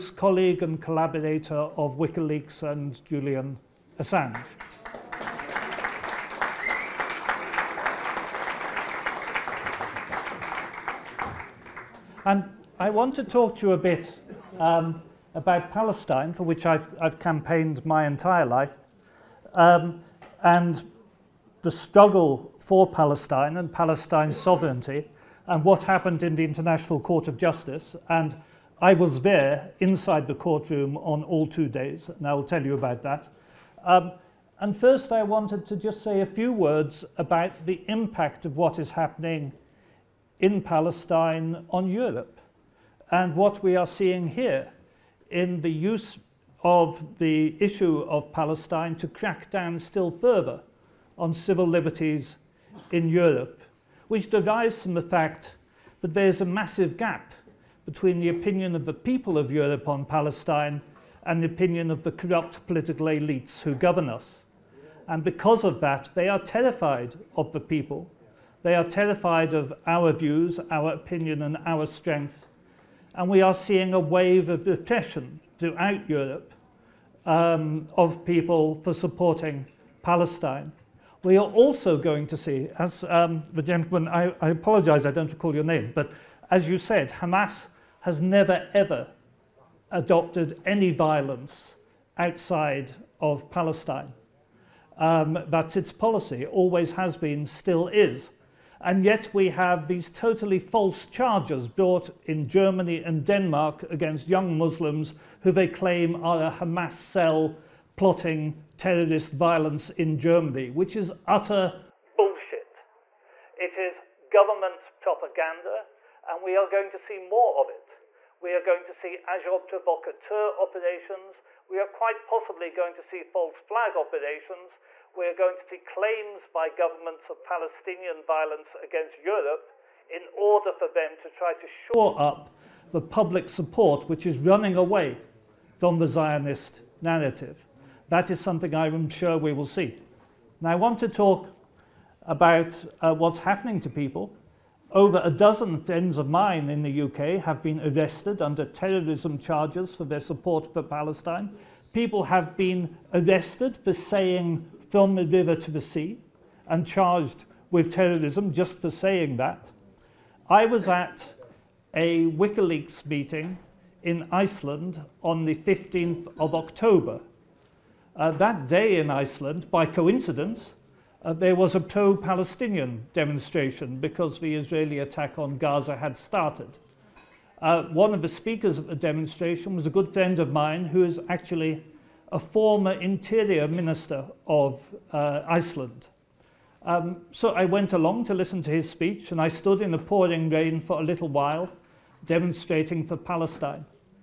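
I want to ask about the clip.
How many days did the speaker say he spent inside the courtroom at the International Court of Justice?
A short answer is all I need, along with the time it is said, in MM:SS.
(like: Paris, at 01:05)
2, at 00:31.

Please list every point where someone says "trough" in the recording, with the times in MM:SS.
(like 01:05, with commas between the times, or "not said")
not said.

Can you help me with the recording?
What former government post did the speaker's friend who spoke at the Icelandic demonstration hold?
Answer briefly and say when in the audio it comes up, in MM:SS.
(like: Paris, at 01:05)
Interior minister, at 03:02.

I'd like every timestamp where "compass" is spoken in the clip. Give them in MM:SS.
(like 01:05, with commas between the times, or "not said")
not said.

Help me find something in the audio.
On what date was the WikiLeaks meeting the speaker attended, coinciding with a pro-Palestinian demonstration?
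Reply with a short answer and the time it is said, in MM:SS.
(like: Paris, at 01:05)
15th of October, at 02:45.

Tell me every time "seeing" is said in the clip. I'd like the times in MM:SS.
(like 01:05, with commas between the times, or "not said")
00:43, 01:13.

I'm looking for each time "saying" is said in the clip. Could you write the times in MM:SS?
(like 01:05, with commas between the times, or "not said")
02:33, 02:38.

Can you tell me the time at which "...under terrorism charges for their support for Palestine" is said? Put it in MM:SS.
02:28.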